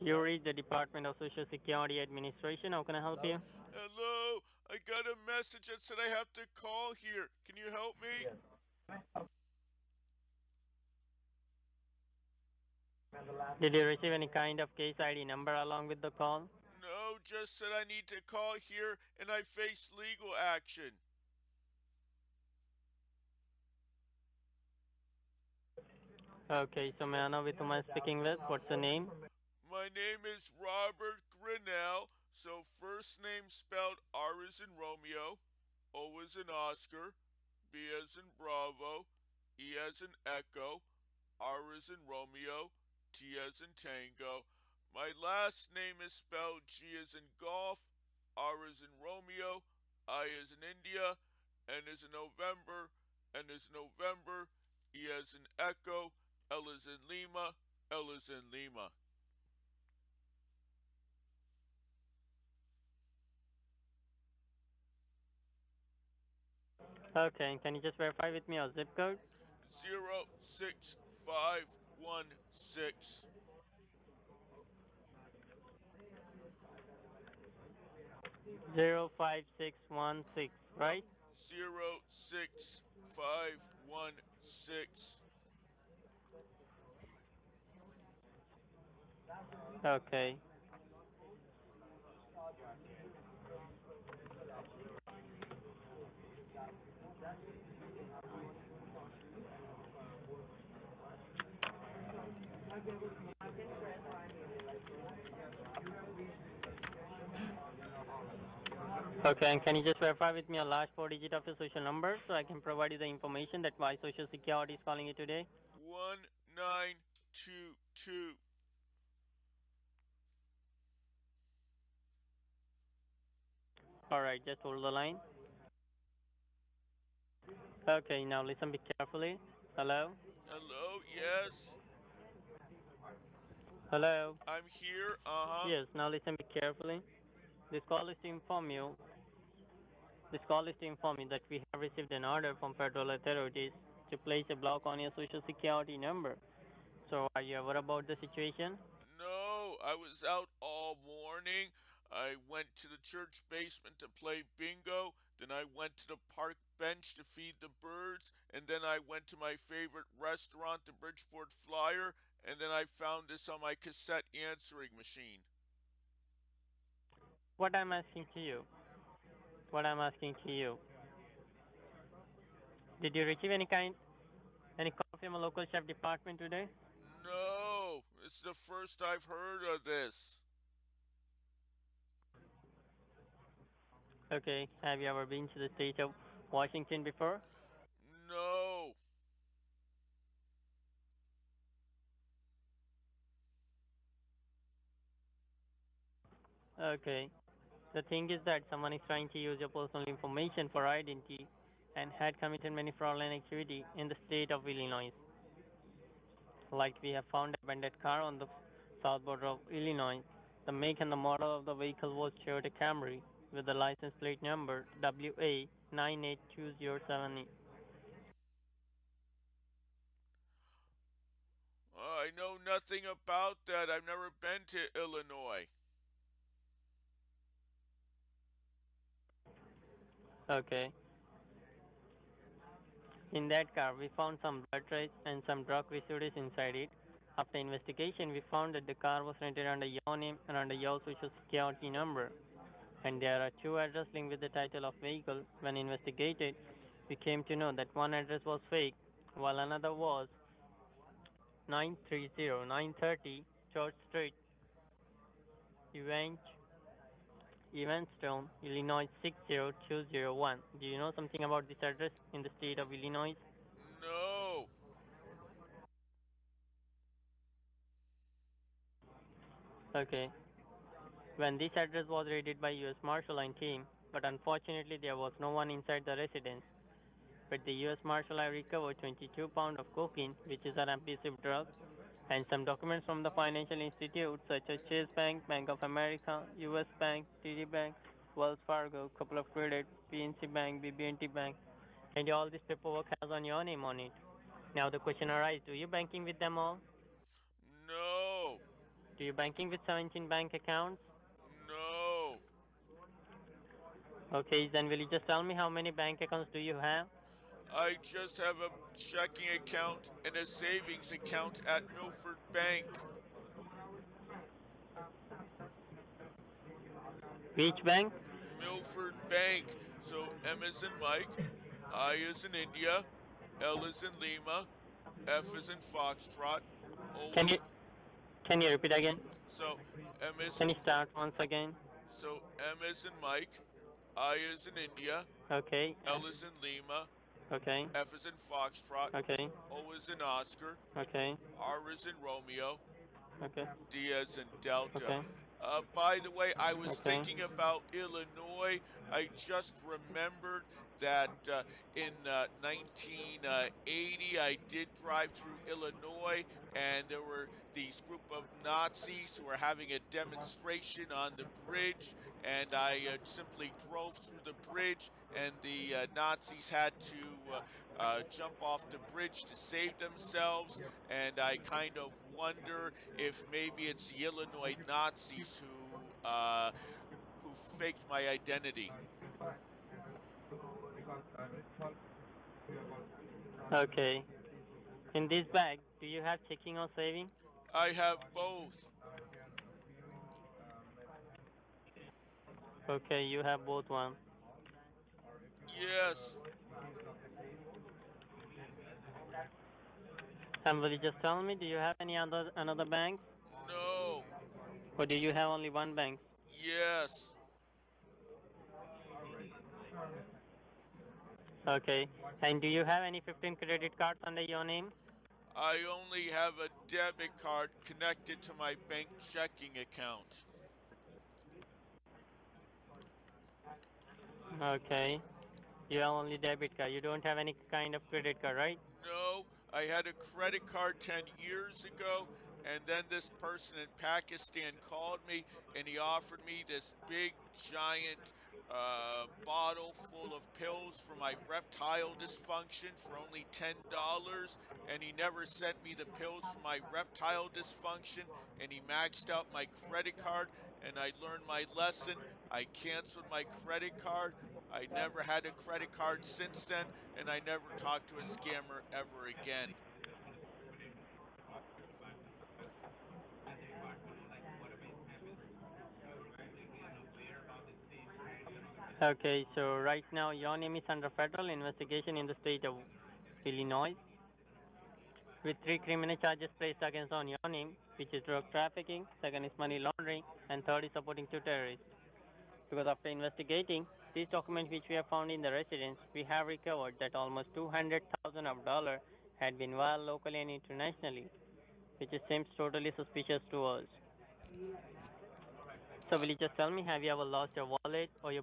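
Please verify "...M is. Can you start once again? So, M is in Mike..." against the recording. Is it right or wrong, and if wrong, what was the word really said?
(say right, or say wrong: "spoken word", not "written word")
right.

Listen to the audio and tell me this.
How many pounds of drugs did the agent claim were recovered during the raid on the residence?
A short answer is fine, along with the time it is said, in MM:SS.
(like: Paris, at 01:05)
22, at 04:38.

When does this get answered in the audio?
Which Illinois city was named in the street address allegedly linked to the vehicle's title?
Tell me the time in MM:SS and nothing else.
04:17.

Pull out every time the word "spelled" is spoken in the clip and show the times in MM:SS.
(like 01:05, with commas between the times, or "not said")
00:33, 00:46.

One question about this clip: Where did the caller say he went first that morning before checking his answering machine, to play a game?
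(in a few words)
church basement.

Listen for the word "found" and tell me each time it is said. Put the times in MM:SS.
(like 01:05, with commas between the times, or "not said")
02:42, 03:27, 03:54, 03:58, 08:05.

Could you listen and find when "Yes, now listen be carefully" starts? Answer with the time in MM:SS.
02:15.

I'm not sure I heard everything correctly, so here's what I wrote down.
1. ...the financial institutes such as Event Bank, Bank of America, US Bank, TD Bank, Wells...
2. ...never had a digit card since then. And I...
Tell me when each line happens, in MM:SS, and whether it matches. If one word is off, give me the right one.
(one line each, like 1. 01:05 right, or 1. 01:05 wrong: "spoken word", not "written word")
1. 04:43 wrong: "Chase", not "Event"
2. 07:34 wrong: "credit", not "digit".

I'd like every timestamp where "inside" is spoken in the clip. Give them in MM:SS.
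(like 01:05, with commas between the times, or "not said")
03:56, 04:35.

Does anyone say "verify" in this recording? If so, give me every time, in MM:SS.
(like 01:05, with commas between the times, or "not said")
01:07, 01:49.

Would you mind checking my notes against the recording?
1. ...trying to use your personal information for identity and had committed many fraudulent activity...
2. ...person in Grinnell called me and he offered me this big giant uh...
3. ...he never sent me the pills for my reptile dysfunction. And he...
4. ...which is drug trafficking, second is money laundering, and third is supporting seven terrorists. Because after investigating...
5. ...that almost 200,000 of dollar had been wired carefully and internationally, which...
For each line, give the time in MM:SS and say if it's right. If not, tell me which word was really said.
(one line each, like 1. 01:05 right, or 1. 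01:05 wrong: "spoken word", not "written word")
1. 03:19 right
2. 07:13 wrong: "Pakistan", not "Grinnell"
3. 07:25 right
4. 07:57 wrong: "two", not "seven"
5. 08:06 wrong: "locally", not "carefully".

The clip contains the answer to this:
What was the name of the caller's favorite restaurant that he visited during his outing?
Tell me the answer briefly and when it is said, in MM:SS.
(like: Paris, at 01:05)
Bridgeport Flyer, at 02:40.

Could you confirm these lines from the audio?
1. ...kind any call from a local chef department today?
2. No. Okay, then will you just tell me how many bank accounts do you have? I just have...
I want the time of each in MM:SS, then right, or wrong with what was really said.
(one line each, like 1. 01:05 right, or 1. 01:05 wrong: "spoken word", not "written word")
1. 02:53 right
2. 05:01 right.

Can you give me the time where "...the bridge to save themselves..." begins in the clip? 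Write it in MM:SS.
06:08.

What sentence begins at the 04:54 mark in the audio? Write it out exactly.
Now the question arises, do you banking with them all?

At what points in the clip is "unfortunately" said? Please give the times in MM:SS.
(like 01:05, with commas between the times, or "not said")
04:34.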